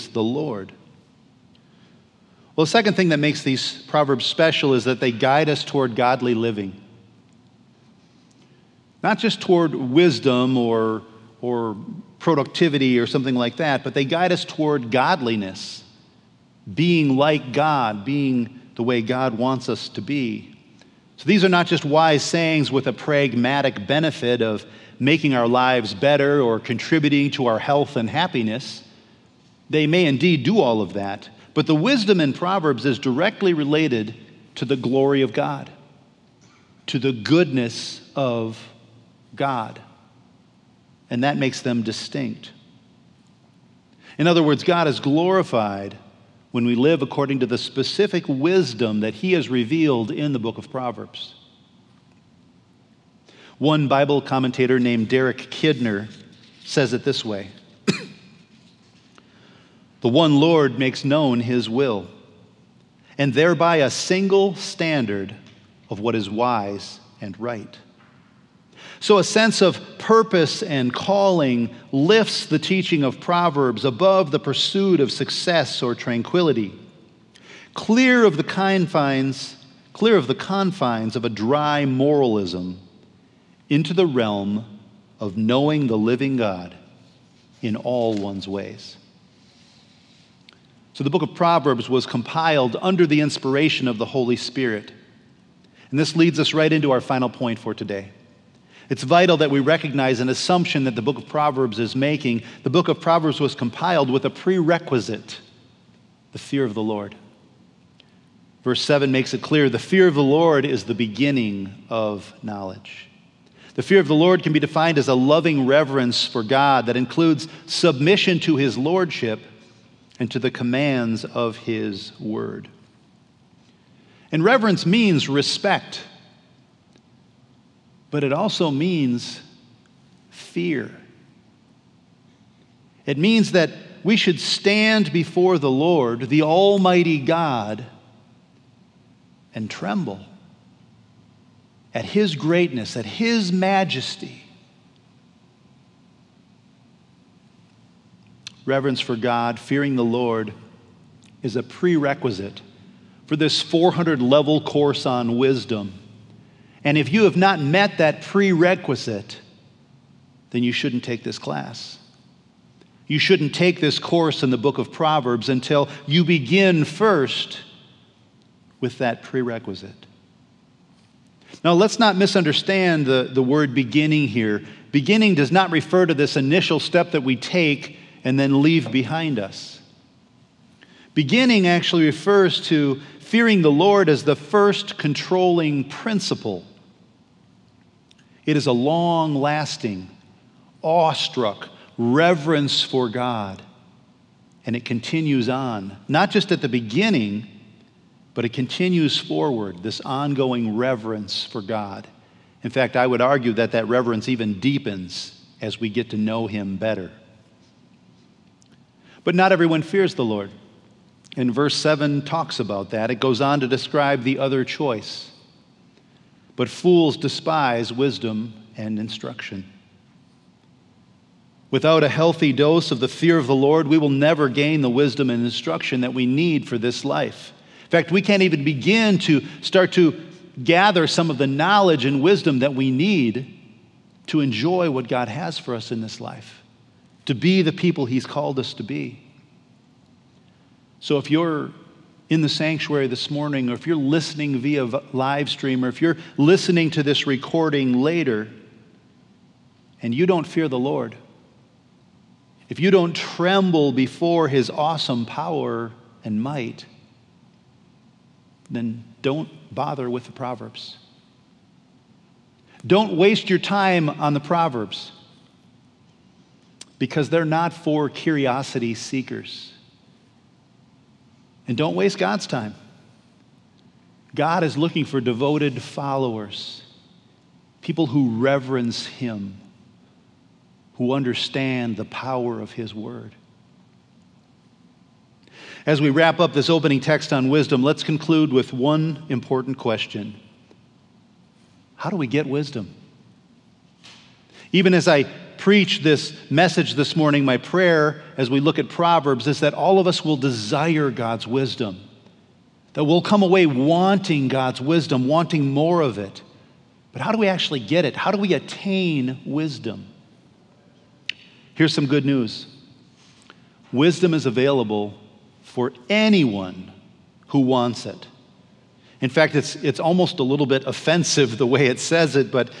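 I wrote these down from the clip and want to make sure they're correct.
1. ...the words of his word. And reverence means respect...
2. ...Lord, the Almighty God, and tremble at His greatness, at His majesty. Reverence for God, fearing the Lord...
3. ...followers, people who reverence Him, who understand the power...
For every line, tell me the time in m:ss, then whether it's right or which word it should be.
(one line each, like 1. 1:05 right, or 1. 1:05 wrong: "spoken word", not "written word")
1. 2:00 wrong: "commands", not "words"
2. 2:15 right
3. 4:35 right.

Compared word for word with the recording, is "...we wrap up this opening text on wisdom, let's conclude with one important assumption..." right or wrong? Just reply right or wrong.
wrong.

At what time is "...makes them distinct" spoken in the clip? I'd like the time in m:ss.
0:41.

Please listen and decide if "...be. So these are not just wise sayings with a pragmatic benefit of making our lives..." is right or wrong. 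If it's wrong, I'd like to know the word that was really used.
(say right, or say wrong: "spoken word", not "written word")
right.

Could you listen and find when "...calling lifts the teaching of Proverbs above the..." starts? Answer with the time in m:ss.
1:10.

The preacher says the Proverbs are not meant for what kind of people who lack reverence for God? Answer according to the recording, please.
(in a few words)
curiosity seekers.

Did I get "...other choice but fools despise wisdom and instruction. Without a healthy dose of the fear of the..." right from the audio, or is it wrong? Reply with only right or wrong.
right.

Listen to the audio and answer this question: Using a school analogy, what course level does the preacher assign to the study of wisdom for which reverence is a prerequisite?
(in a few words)
400.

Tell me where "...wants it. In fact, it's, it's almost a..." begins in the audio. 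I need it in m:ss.
5:17.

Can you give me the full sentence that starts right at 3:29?
But not everyone fears the Lord.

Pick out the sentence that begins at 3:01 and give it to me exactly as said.
Beginning actually refers to fearing the Lord as the first controlling principle it is a long lasting, awestruck reverence for God.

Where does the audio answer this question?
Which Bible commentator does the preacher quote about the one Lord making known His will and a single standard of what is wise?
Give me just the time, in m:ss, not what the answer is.
0:55.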